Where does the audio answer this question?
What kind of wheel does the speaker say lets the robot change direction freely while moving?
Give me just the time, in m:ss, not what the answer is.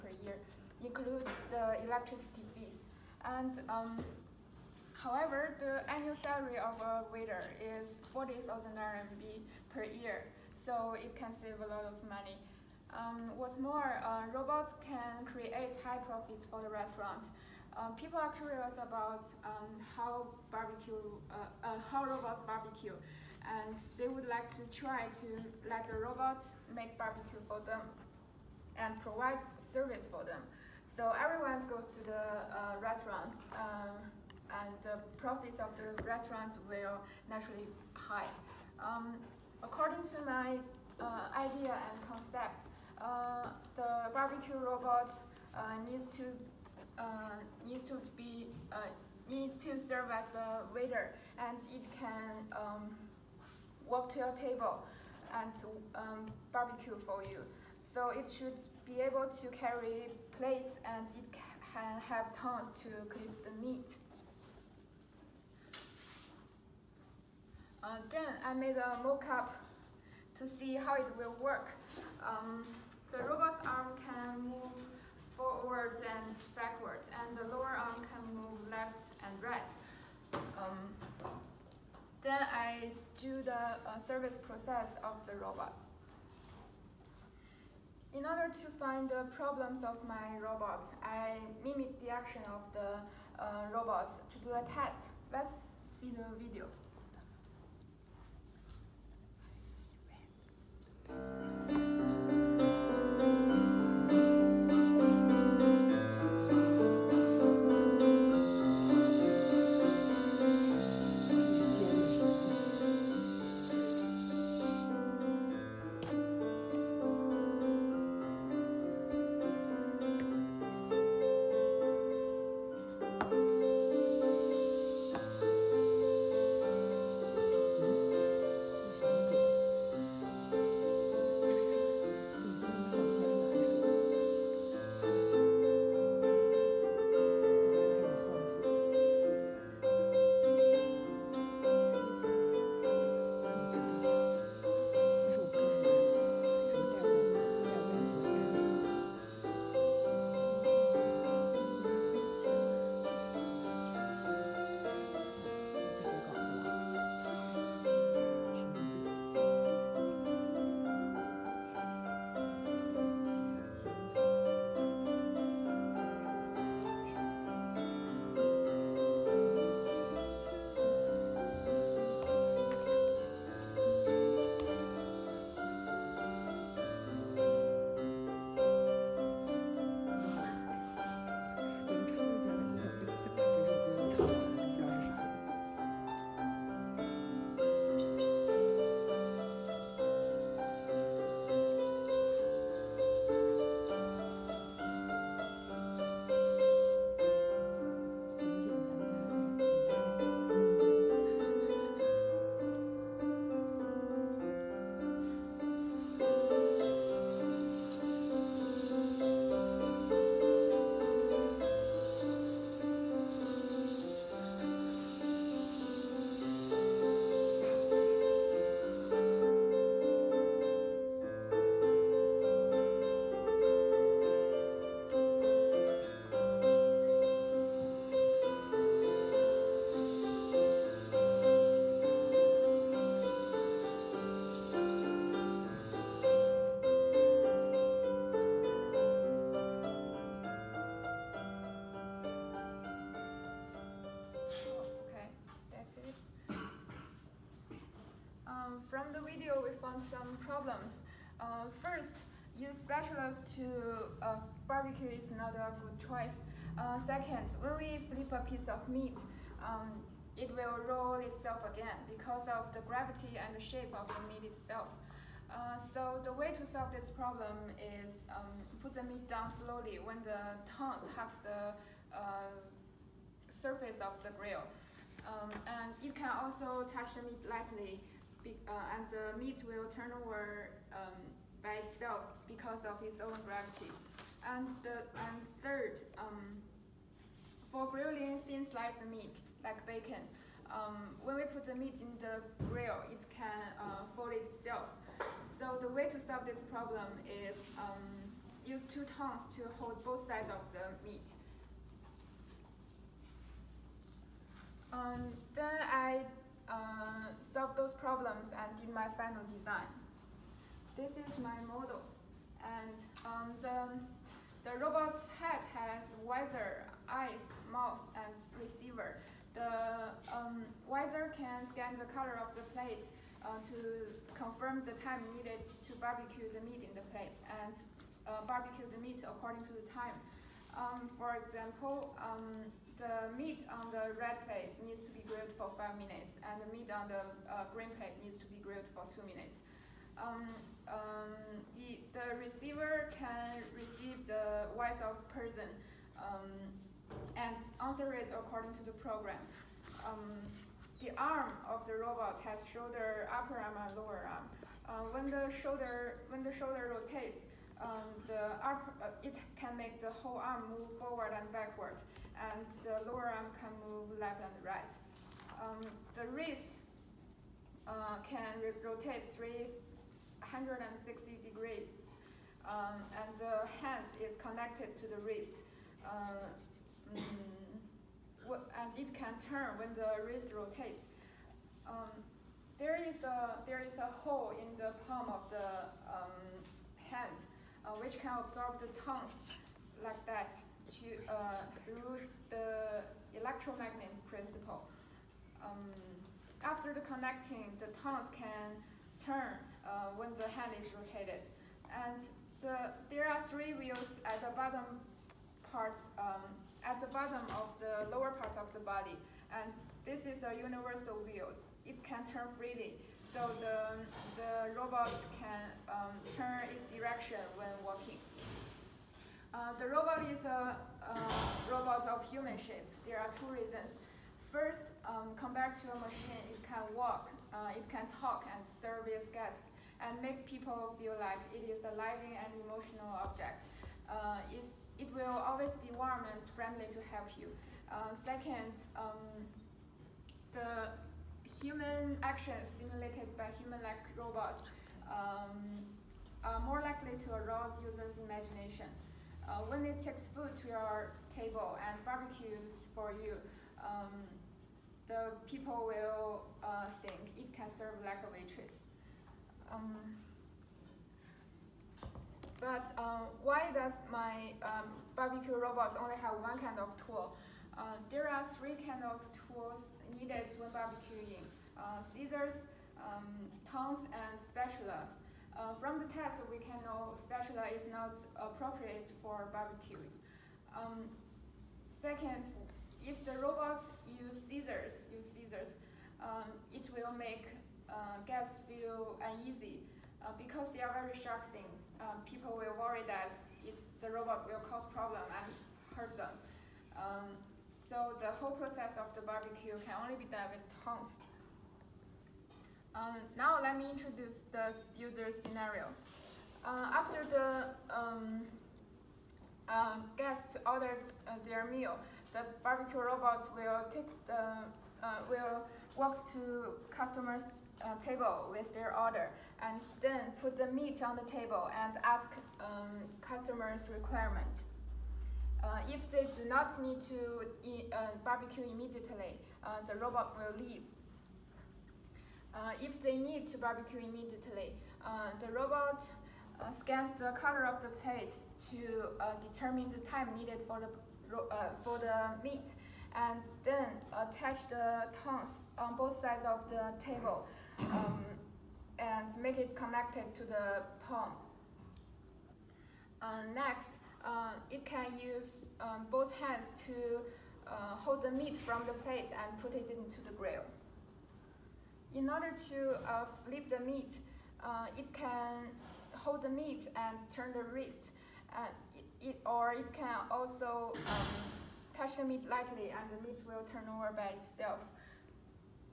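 6:50.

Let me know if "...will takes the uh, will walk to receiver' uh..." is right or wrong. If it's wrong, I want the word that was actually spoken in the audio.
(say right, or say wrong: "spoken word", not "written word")
wrong: "customers", not "receiver".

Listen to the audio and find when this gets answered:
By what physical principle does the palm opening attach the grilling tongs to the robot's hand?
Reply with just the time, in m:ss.
6:33.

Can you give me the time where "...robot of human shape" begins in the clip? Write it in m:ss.
7:01.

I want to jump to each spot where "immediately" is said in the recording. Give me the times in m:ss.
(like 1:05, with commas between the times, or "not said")
8:48, 8:53.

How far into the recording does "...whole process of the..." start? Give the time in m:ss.
8:18.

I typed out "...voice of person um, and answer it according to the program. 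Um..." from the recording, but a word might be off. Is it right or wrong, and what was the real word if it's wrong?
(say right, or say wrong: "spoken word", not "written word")
right.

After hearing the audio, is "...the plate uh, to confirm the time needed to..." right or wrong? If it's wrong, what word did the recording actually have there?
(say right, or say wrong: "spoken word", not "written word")
right.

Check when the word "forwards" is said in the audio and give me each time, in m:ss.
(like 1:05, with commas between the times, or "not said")
1:15, 6:00.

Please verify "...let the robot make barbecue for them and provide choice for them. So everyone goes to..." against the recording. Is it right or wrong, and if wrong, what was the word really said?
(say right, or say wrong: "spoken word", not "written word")
wrong: "service", not "choice".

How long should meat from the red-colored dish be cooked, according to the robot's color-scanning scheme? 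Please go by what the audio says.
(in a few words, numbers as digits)
5 minutes.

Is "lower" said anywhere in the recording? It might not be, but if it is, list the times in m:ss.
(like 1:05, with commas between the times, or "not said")
1:17, 5:53, 6:03, 6:48.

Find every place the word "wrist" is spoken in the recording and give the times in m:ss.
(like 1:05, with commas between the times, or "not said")
6:06, 6:15, 6:20, 9:27.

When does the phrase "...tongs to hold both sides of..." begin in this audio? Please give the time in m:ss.
4:59.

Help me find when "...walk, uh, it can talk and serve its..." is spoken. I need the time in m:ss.
7:06.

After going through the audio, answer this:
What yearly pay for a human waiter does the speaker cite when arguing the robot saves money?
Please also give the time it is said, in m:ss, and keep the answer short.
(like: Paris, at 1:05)
40,000 RMB, at 0:08.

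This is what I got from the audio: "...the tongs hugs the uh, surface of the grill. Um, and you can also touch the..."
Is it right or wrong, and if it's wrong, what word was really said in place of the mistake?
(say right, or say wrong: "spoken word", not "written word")
right.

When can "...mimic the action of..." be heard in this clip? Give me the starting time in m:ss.
1:31.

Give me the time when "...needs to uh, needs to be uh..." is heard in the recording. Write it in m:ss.
0:45.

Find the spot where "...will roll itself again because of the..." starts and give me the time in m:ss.
4:20.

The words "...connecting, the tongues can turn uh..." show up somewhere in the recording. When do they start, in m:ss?
6:36.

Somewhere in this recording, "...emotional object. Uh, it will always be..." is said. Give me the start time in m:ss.
7:12.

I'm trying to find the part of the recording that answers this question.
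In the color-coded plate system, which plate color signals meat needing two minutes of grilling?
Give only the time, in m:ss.
5:37.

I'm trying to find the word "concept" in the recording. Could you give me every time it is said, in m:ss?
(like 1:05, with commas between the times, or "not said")
0:42.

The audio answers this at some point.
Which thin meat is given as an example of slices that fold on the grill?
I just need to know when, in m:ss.
4:49.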